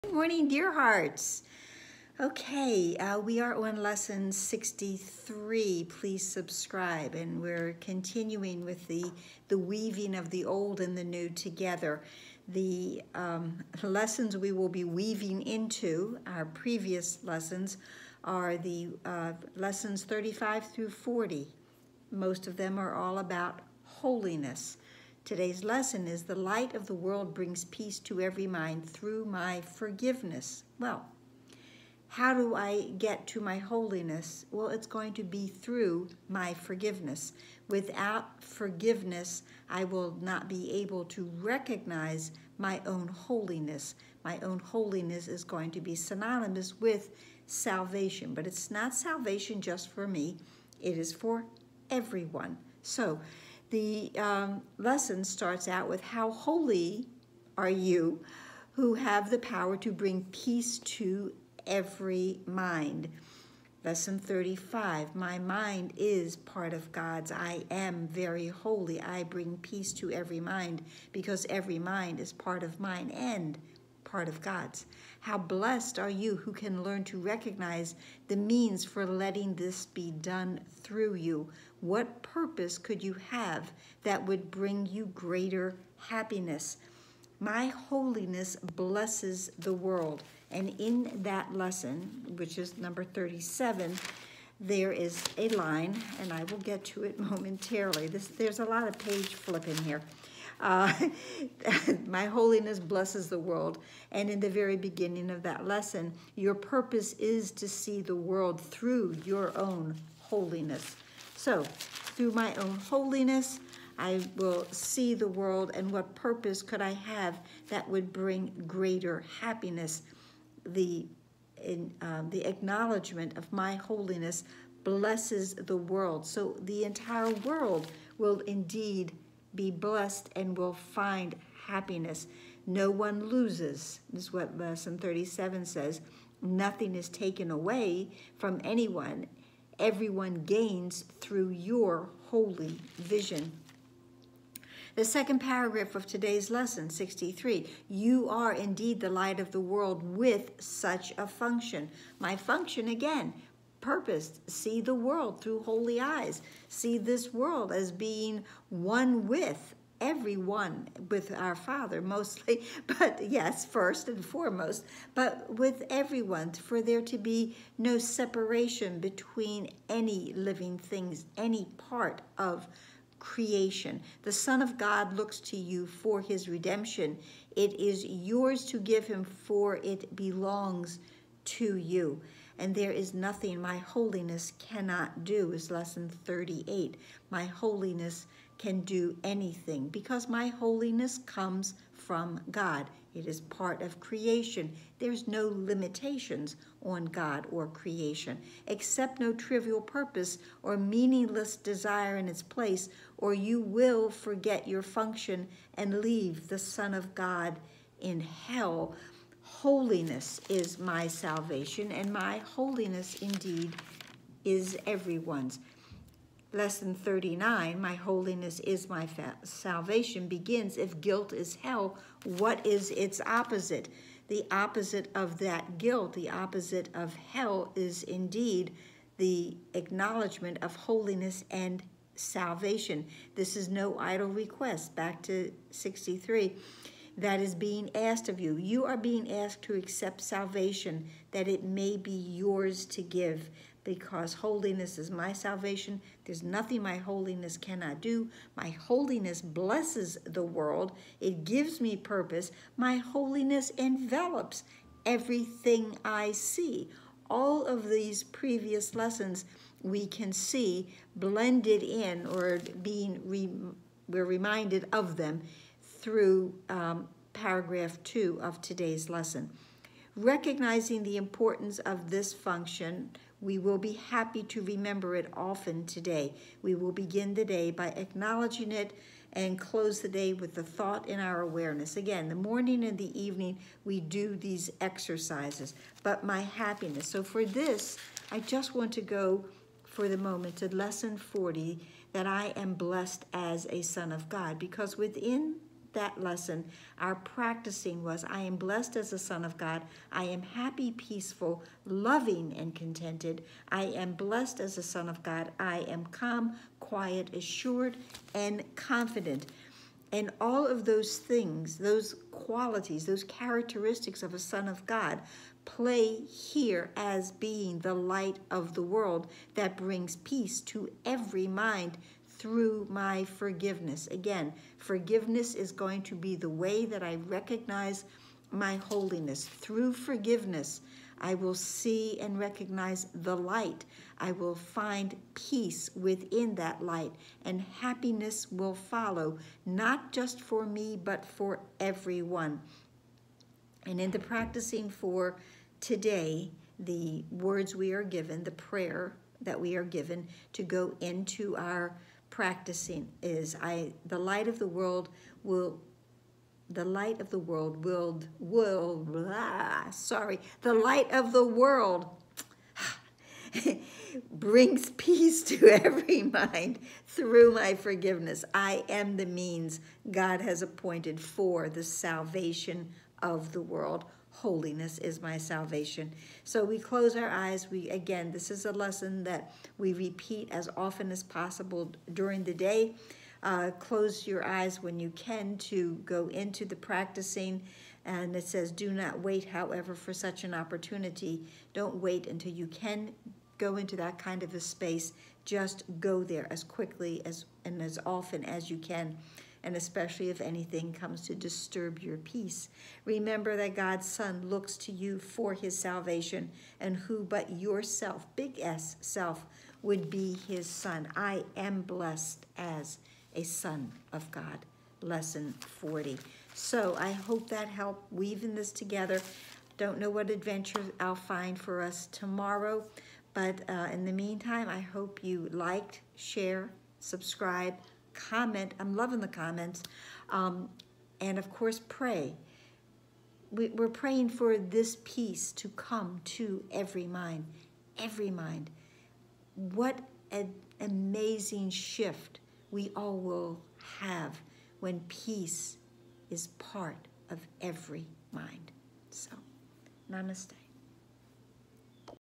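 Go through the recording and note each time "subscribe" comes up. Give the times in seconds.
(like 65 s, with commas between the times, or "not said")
6 s, 426 s.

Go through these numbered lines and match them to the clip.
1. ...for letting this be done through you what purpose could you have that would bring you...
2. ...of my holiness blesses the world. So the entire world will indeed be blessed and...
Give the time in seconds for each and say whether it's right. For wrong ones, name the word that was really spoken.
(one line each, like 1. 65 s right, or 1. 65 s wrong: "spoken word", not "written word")
1. 78 s right
2. 123 s right.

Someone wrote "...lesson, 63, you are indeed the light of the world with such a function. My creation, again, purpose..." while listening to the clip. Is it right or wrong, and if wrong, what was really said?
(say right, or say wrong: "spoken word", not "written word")
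wrong: "function", not "creation".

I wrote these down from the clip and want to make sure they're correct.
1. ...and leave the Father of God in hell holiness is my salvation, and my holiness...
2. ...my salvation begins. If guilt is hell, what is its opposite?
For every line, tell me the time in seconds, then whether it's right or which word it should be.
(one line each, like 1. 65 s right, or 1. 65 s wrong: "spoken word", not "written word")
1. 205 s wrong: "Son", not "Father"
2. 218 s right.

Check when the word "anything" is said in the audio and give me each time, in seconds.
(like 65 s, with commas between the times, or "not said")
189 s, 400 s.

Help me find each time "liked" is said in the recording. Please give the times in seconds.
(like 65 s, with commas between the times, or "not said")
425 s.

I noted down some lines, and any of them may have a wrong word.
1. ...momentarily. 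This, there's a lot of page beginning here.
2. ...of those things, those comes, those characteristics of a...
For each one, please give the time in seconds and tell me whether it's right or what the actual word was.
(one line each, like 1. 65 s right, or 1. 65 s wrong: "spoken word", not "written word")
1. 97 s wrong: "flipping", not "beginning"
2. 310 s wrong: "qualities", not "comes".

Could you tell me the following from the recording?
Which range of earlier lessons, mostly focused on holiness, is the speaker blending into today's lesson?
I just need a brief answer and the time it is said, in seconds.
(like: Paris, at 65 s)
35 through 40, at 20 s.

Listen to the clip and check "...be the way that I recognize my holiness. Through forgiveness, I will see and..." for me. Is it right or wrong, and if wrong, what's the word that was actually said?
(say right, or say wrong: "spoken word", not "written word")
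right.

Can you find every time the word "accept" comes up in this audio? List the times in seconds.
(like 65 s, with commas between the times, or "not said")
198 s, 239 s.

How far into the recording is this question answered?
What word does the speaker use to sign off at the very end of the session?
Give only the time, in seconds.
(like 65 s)
450 s.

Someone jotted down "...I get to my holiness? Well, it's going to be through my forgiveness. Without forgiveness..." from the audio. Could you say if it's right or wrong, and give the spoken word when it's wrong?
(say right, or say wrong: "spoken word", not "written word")
right.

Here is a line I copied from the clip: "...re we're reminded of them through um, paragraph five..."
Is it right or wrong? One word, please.
wrong.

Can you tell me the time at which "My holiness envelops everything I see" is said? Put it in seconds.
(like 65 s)
252 s.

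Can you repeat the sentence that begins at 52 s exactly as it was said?
So, the um, lesson starts out with How holy are you who have the power to bring peace to every mind?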